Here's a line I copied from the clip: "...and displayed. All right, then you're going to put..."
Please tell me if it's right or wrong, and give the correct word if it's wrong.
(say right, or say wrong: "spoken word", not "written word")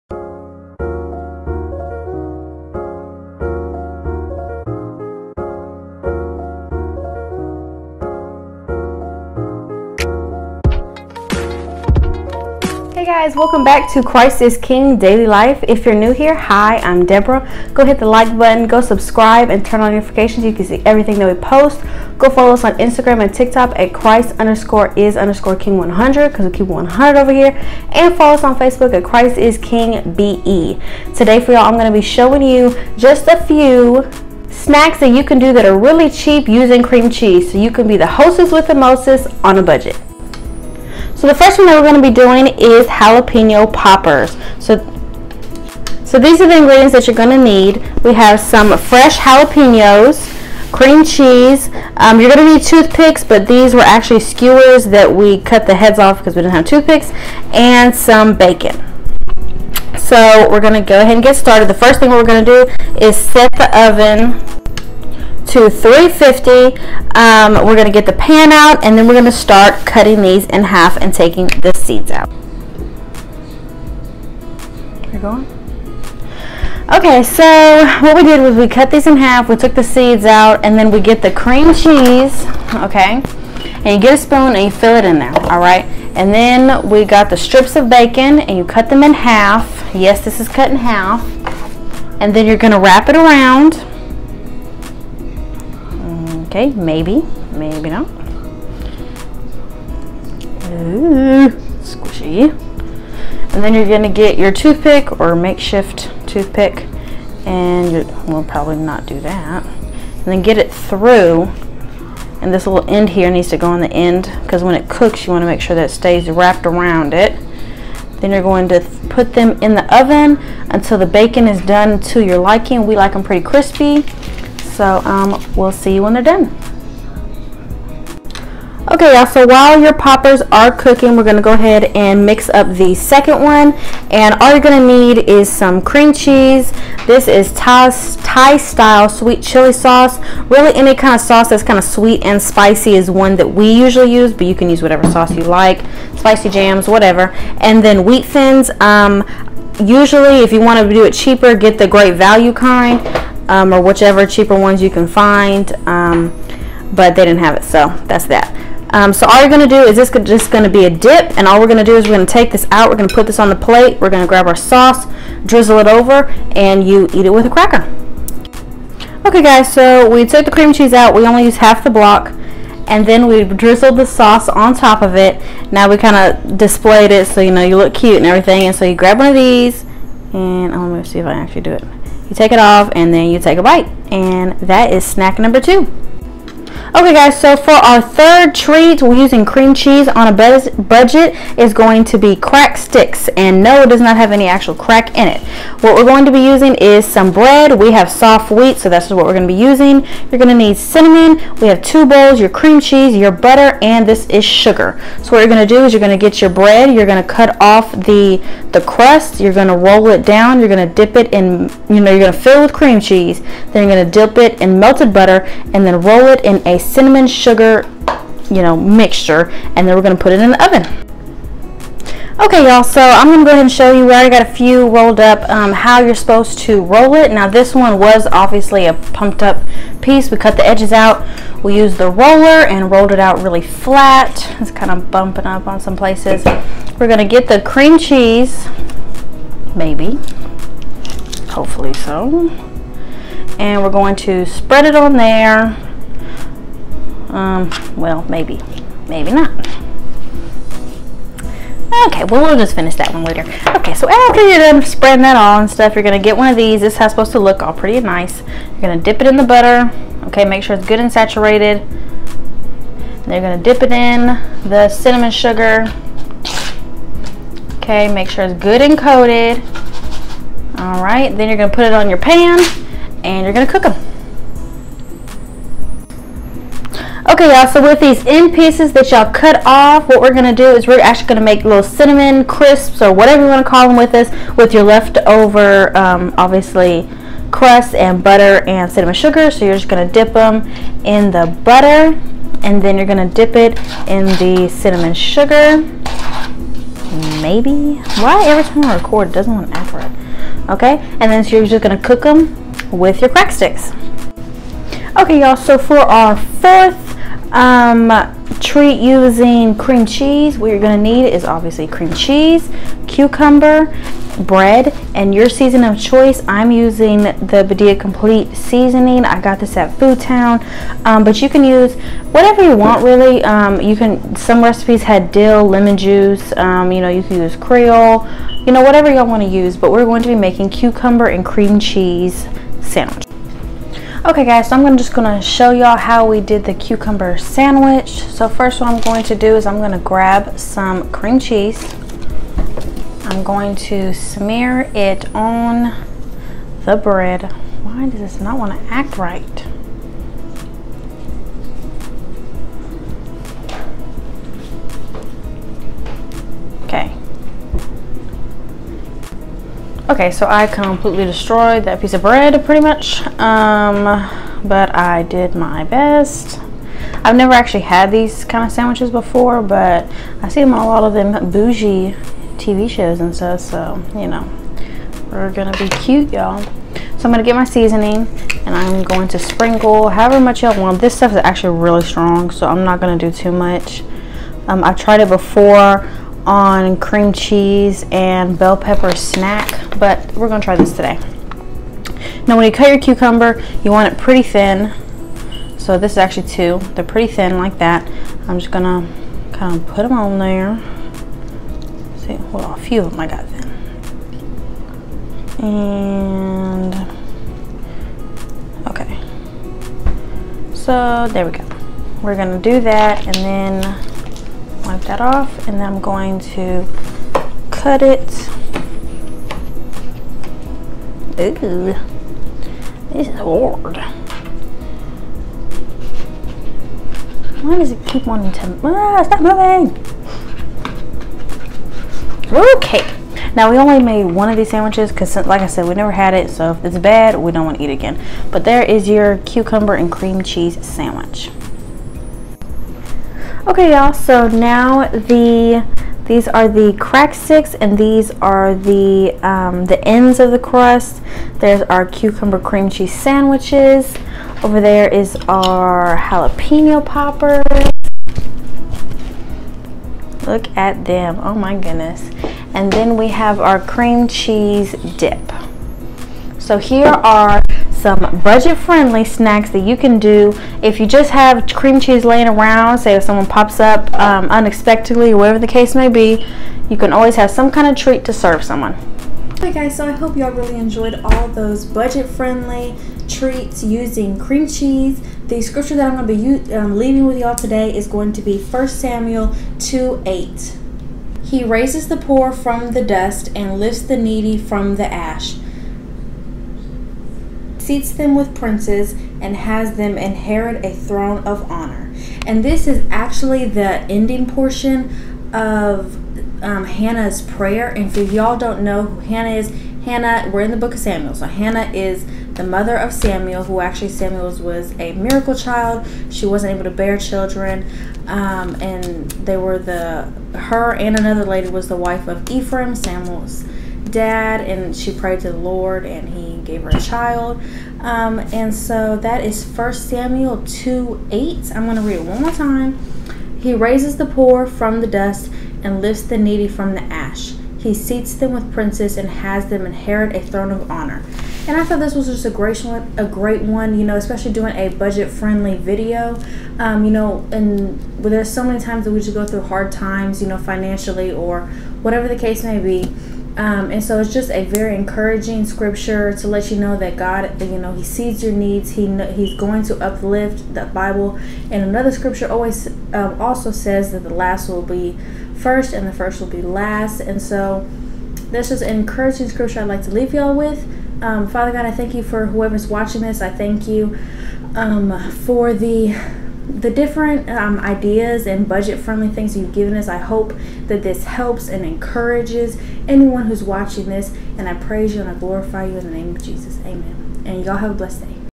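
wrong: "coated", not "displayed".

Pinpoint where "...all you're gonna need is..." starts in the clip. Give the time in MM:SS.
02:14.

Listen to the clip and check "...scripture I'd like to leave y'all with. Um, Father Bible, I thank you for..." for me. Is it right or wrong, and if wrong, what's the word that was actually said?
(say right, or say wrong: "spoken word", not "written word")
wrong: "God", not "Bible".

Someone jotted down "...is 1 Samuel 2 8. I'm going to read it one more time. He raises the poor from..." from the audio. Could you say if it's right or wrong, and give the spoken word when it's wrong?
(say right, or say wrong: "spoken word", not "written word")
right.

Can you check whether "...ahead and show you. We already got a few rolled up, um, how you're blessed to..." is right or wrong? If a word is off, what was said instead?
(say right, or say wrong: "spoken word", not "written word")
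wrong: "supposed", not "blessed".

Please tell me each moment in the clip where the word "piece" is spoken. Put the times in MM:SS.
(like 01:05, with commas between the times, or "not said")
03:50, 04:38, 06:02.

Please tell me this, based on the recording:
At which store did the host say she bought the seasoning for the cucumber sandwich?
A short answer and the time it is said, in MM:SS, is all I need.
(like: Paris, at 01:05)
Food Town, at 05:19.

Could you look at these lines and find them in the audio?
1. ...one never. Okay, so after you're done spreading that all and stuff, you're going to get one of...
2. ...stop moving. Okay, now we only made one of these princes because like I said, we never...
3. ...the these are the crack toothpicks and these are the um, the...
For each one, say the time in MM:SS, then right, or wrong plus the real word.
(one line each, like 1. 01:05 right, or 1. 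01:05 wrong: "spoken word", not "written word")
1. 04:13 wrong: "later", not "never"
2. 07:09 wrong: "sandwiches", not "princes"
3. 07:25 wrong: "sticks", not "toothpicks".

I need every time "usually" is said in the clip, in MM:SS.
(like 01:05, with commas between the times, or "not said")
02:23, 02:29.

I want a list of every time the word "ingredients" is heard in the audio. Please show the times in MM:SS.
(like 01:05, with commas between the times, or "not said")
00:46.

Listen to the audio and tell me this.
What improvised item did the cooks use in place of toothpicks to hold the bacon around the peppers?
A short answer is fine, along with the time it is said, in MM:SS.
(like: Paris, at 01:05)
skewers, at 00:54.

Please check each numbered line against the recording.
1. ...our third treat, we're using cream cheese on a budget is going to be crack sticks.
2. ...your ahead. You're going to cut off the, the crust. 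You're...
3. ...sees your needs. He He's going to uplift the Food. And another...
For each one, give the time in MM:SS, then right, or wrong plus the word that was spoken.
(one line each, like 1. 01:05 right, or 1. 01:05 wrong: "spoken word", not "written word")
1. 03:07 right
2. 03:26 wrong: "bread", not "ahead"
3. 09:18 wrong: "Bible", not "Food".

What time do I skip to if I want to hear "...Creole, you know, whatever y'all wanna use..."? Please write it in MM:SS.
05:27.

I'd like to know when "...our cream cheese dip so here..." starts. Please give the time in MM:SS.
07:43.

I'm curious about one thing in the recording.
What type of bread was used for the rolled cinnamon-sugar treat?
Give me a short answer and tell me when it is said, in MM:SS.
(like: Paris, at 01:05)
soft wheat, at 03:18.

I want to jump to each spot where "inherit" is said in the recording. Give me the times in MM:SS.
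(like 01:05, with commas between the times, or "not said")
08:20, 08:59.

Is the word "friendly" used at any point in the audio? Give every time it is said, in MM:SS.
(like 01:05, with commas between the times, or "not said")
07:48, 08:01, 09:04, 09:38.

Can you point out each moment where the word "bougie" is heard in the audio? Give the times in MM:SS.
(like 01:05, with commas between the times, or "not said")
06:11.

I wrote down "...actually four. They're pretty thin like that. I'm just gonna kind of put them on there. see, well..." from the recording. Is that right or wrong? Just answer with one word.
wrong.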